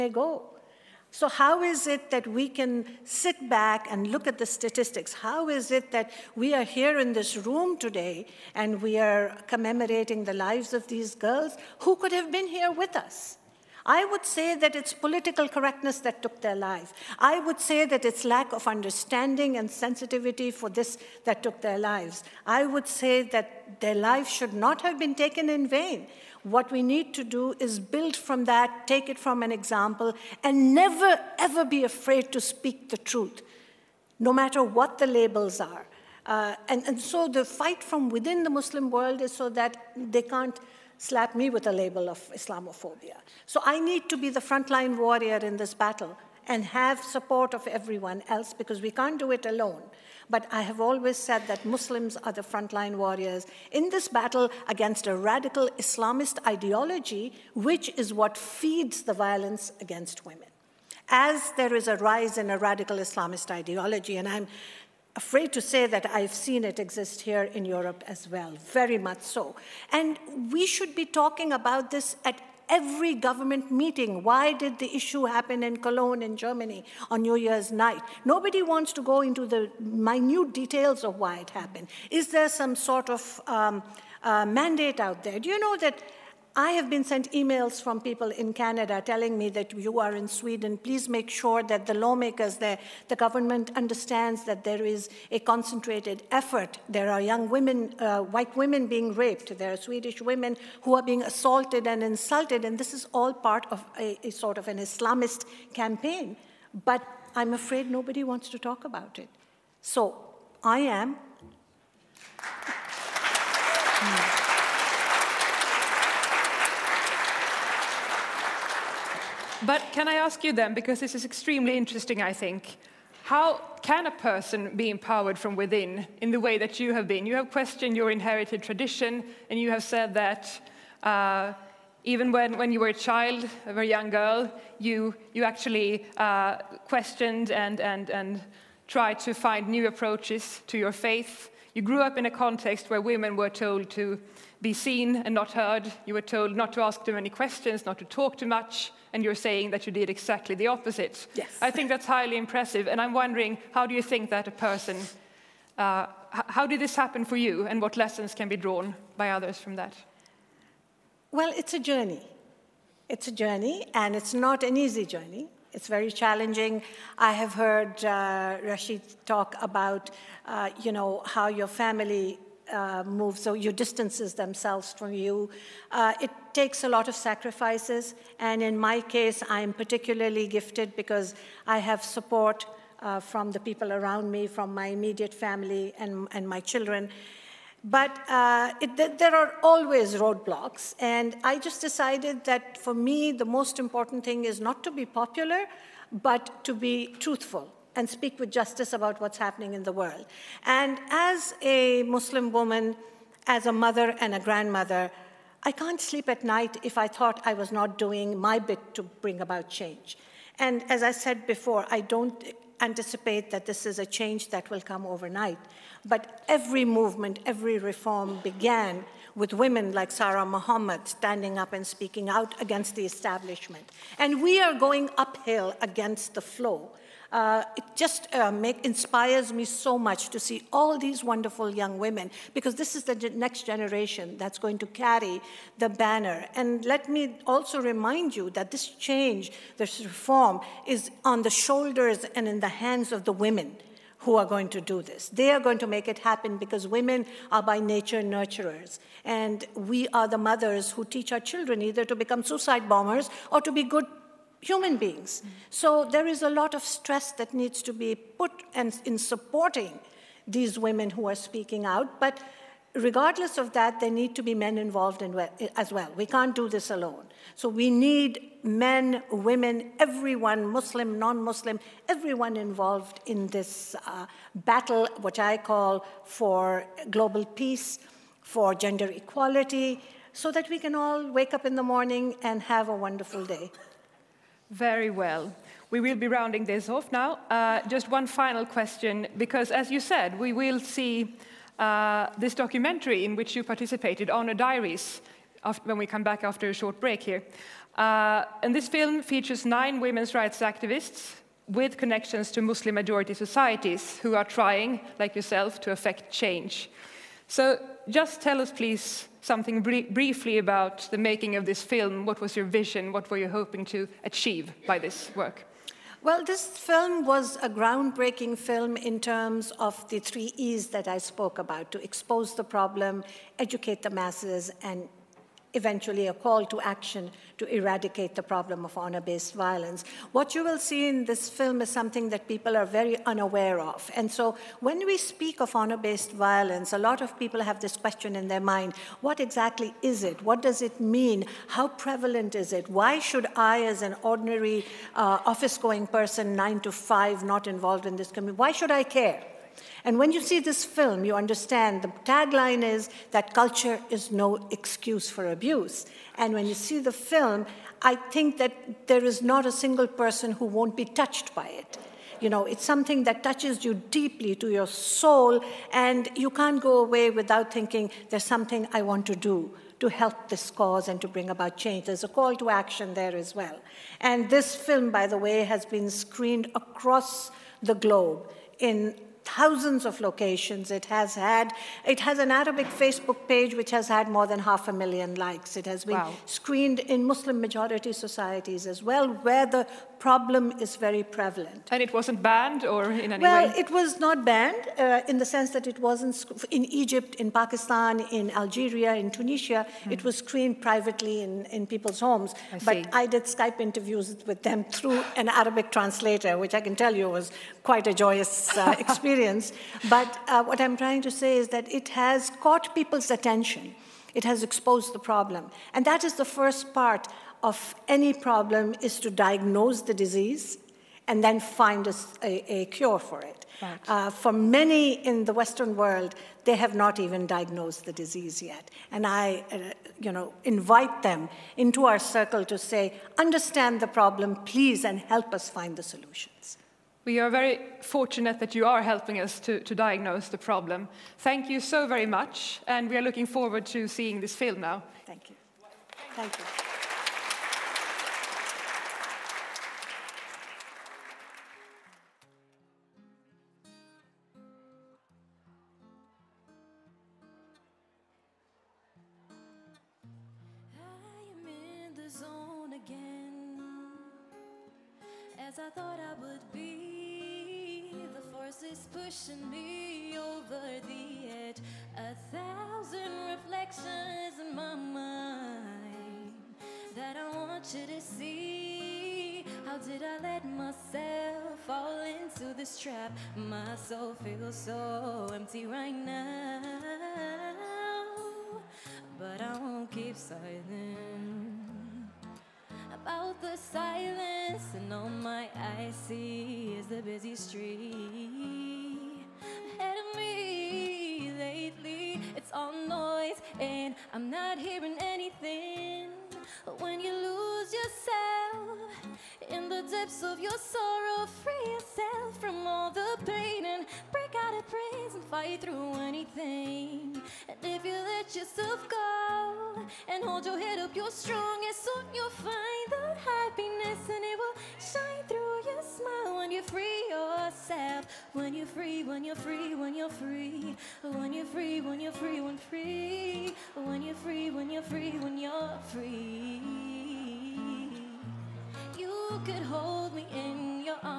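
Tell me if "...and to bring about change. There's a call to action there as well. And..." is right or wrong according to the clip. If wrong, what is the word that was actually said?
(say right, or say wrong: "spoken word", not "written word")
right.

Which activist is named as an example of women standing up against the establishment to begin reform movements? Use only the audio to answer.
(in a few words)
Sara Mohammed.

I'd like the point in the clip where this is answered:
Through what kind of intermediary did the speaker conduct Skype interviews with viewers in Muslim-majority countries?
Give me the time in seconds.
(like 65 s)
405 s.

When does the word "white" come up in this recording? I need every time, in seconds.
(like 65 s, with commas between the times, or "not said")
98 s.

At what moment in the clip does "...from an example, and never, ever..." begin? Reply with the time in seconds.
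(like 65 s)
29 s.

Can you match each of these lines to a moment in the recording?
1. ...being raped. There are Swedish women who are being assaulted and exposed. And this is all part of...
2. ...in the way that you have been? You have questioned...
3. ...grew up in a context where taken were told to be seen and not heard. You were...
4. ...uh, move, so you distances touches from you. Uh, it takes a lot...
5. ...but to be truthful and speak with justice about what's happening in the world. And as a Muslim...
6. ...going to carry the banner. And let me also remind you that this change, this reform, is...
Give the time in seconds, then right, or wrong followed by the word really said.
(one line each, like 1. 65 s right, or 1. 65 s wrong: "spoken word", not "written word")
1. 98 s wrong: "insulted", not "exposed"
2. 126 s right
3. 141 s wrong: "women", not "taken"
4. 172 s wrong: "themselves", not "touches"
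5. 196 s right
6. 234 s right.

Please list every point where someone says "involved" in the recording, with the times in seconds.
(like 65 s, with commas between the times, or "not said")
264 s, 272 s, 347 s.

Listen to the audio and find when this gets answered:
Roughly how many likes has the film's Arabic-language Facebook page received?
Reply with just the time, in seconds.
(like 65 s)
384 s.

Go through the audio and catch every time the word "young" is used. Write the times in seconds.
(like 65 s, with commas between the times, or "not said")
97 s, 133 s, 231 s.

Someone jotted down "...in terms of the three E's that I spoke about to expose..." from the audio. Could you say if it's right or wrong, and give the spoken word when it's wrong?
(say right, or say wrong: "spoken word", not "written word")
right.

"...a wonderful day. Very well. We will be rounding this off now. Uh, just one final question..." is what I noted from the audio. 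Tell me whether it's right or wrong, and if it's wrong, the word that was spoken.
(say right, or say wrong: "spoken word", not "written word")
right.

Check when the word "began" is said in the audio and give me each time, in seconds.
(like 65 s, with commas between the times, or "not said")
218 s.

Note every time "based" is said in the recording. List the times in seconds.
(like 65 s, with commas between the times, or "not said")
329 s, 335 s.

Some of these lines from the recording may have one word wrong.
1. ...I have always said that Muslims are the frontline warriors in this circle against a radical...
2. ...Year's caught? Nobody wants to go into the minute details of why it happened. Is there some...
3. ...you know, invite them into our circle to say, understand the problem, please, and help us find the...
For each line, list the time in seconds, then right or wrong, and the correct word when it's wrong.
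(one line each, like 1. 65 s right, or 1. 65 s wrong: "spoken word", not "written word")
1. 50 s wrong: "battle", not "circle"
2. 77 s wrong: "night", not "caught"
3. 430 s right.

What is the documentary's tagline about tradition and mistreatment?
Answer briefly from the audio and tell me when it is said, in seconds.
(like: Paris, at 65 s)
Culture is no excuse for abuse, at 353 s.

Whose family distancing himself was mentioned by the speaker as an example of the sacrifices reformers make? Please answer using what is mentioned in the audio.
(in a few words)
Rashid.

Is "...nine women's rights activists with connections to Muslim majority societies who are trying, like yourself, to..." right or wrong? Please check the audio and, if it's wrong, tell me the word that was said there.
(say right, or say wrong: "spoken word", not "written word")
right.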